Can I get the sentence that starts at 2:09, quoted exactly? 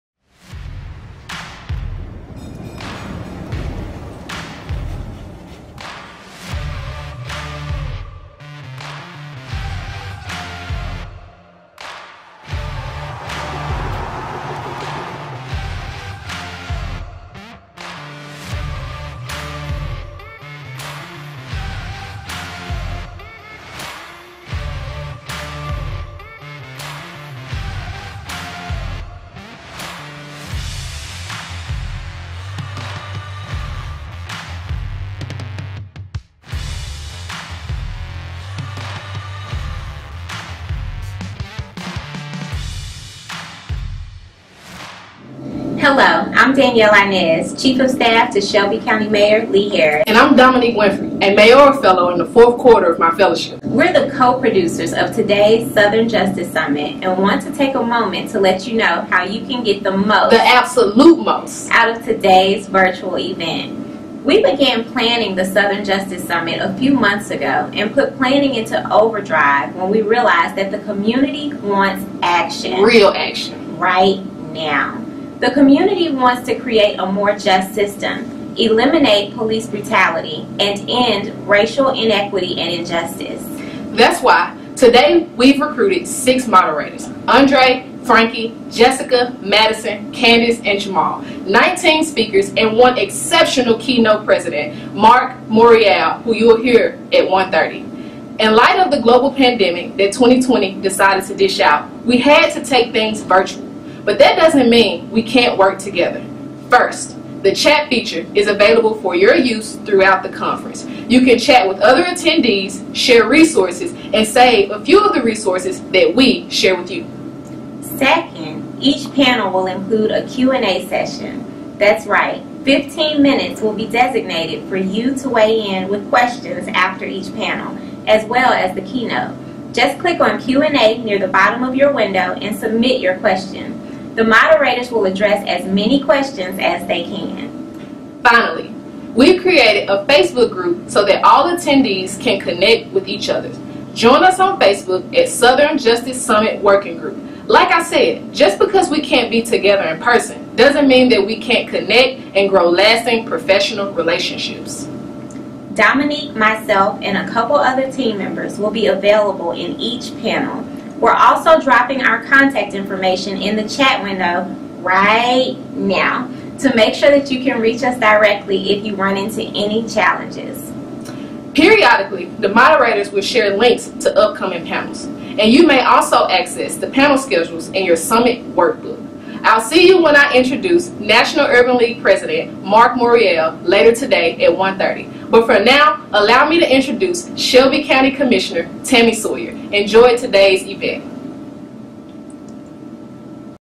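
Just click on Q&A near the bottom of your window and submit your question.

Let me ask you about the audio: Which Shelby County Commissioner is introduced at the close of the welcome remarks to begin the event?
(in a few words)
Tami Sawyer.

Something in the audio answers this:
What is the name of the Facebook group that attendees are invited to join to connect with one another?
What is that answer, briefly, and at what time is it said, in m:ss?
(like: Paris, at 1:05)
Southern Justice Summit Working Group, at 2:25.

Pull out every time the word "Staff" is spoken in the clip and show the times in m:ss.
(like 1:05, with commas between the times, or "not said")
0:47.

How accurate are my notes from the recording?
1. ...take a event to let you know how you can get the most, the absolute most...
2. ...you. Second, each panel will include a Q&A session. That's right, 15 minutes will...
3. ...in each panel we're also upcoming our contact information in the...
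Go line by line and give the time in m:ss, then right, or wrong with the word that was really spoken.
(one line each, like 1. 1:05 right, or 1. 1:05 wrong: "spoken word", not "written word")
1. 0:57 wrong: "moment", not "event"
2. 1:56 right
3. 2:39 wrong: "dropping", not "upcoming".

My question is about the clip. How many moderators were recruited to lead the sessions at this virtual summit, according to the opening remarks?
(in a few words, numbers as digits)
6.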